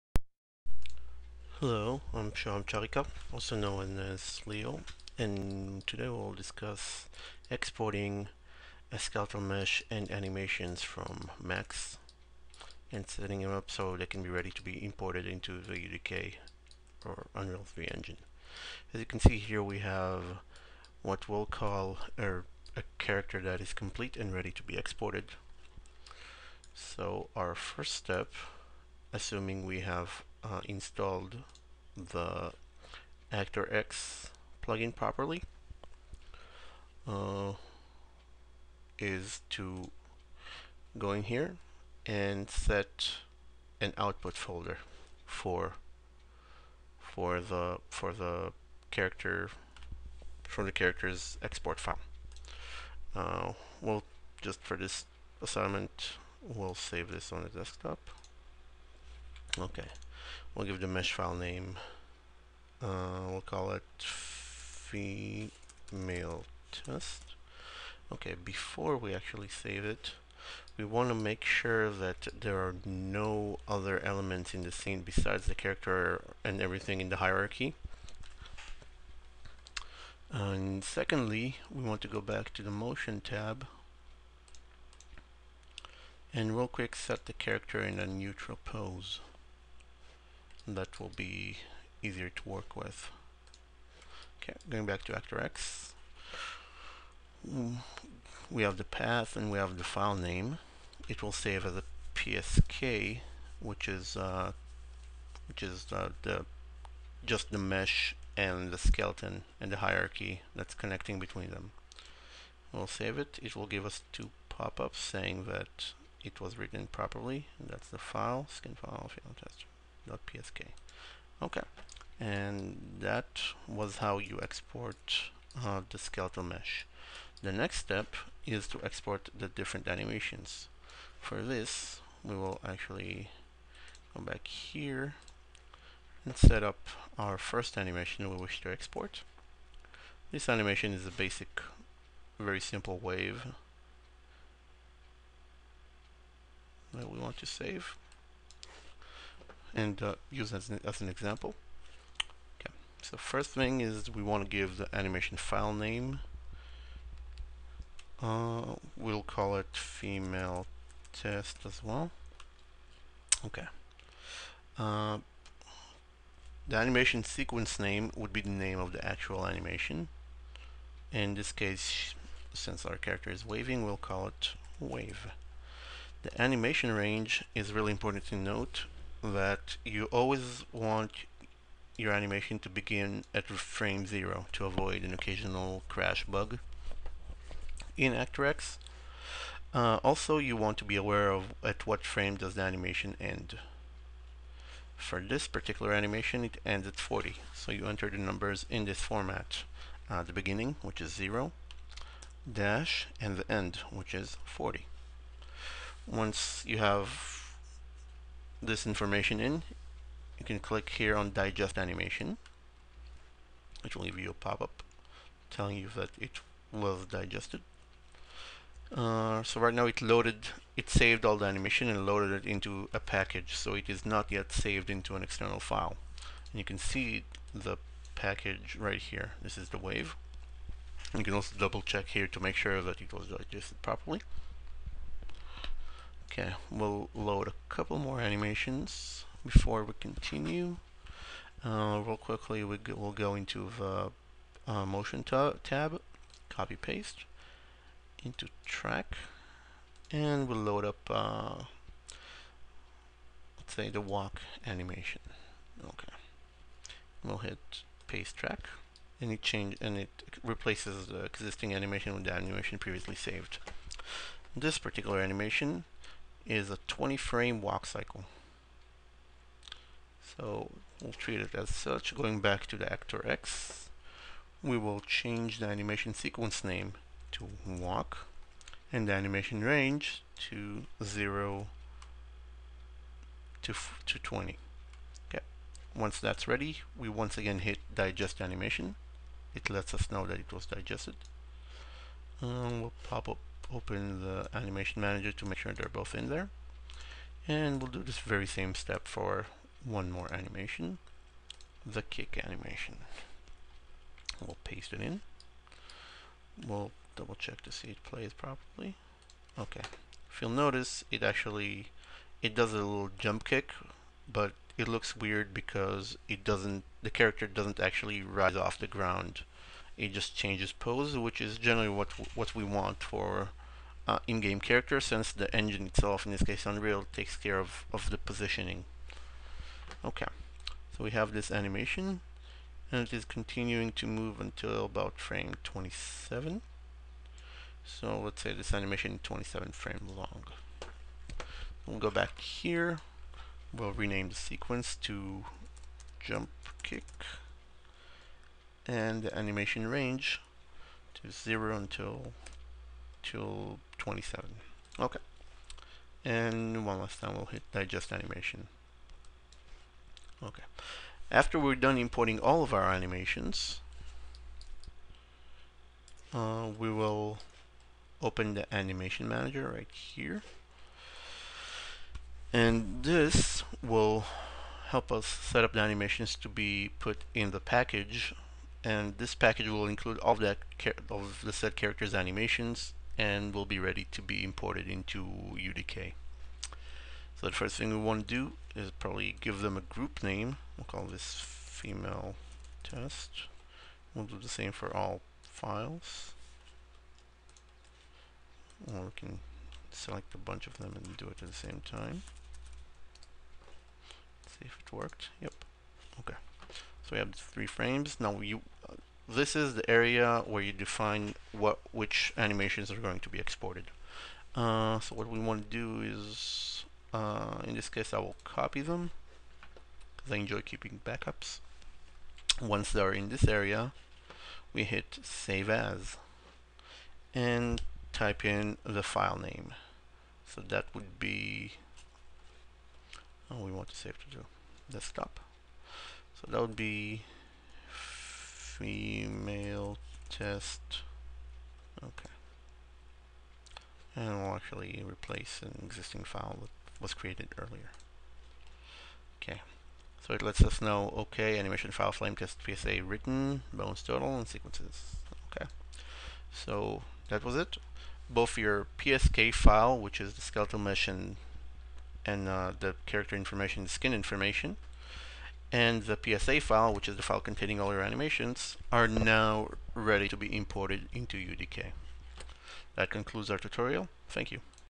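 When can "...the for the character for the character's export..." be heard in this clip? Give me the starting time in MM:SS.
00:47.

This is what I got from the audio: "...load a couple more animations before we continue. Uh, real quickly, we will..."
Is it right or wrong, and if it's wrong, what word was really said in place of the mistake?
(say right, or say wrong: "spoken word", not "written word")
right.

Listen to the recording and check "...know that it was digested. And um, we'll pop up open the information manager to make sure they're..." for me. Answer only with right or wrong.
wrong.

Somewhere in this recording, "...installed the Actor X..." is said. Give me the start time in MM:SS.
00:30.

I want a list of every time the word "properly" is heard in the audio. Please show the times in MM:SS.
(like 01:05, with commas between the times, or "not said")
00:34, 01:56, 03:53, 05:08.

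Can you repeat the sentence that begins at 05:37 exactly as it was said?
So let's say this animation 27 frame long.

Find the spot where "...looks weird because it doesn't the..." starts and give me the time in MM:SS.
05:14.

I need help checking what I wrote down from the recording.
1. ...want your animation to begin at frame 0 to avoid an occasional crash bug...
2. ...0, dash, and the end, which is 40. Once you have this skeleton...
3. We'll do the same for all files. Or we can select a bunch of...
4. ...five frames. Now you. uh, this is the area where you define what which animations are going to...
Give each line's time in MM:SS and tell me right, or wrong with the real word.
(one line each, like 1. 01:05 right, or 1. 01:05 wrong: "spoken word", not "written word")
1. 03:00 right
2. 03:21 wrong: "information", not "skeleton"
3. 06:34 right
4. 06:47 wrong: "three", not "five".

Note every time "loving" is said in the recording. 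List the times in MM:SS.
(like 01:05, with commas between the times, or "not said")
not said.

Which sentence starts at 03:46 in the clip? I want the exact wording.
And you can see the package right here.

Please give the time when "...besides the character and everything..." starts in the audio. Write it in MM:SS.
01:15.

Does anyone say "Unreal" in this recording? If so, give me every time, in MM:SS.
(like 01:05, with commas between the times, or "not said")
00:17, 05:26.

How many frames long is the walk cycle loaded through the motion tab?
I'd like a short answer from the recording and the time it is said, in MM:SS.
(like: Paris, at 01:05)
20, at 04:26.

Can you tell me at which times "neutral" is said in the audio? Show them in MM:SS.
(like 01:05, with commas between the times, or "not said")
01:28.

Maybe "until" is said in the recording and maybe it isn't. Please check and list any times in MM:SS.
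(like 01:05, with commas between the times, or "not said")
05:34, 05:51.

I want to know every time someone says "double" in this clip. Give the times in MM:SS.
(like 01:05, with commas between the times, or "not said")
03:51, 05:07.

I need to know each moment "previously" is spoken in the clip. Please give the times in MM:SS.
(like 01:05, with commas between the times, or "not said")
04:22.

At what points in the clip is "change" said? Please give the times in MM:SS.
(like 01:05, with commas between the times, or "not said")
04:19, 04:35, 05:20.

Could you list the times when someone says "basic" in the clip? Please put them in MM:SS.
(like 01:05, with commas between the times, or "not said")
02:21.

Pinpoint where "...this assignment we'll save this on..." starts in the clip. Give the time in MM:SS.
00:54.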